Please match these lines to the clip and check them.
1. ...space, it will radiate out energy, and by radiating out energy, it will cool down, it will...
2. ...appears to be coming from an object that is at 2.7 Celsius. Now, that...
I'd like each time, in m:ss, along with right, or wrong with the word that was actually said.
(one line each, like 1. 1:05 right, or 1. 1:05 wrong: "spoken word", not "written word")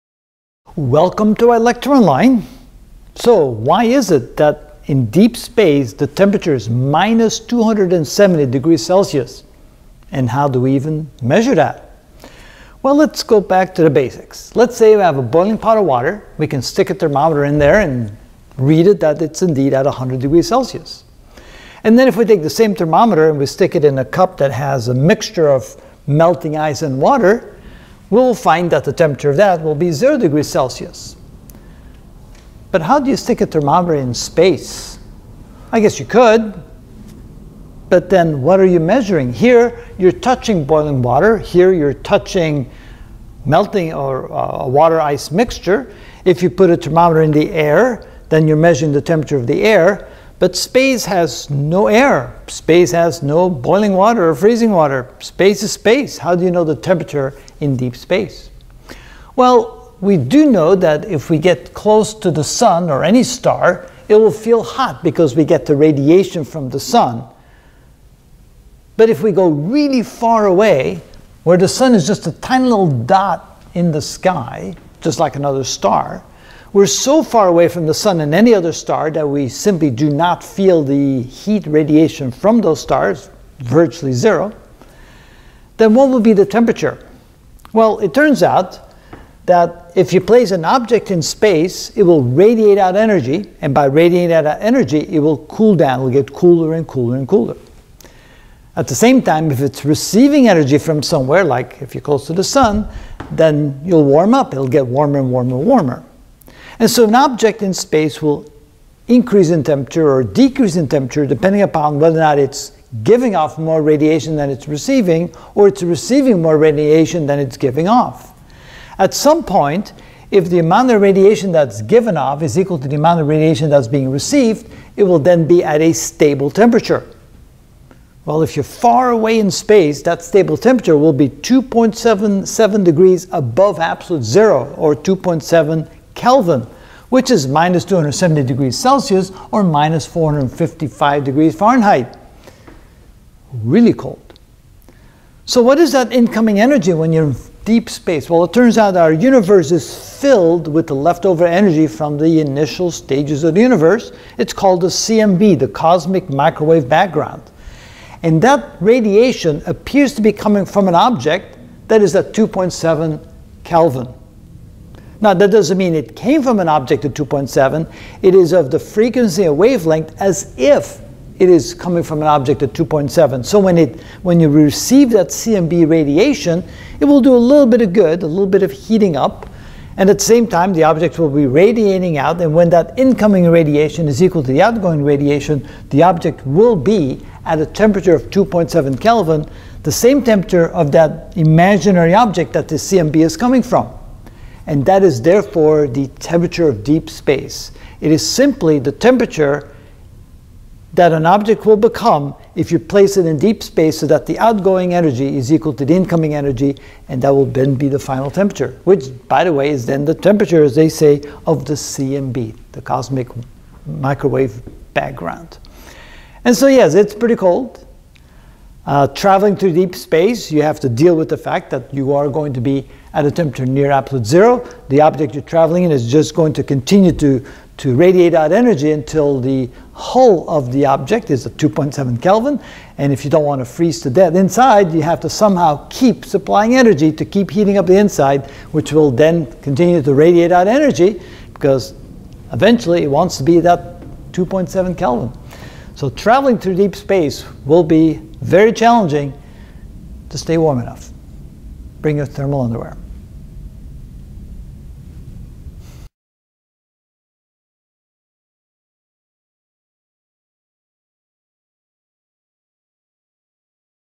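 1. 1:31 right
2. 2:39 wrong: "Kelvin", not "Celsius".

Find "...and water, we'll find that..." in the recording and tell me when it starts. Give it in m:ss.
0:26.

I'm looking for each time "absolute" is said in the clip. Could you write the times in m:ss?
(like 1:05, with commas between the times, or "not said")
2:13, 3:43.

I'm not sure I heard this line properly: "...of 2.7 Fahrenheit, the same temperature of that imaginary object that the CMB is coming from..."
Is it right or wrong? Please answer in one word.
wrong.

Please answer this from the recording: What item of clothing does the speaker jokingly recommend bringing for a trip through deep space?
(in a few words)
thermal underwear.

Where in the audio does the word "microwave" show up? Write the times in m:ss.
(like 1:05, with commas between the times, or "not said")
2:36, 3:33.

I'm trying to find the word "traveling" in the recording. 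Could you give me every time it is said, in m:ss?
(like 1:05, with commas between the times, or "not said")
3:39, 3:45, 4:06.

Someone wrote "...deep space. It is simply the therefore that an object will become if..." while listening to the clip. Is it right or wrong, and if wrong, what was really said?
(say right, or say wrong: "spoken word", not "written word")
wrong: "temperature", not "therefore".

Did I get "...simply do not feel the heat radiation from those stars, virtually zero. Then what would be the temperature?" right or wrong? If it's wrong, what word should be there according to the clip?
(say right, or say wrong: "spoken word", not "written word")
right.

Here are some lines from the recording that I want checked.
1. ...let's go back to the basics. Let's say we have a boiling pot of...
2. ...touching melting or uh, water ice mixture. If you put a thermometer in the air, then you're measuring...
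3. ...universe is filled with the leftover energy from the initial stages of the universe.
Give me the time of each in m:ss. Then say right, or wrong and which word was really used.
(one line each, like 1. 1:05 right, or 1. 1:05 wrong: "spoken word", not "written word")
1. 0:12 right
2. 0:41 right
3. 2:29 right.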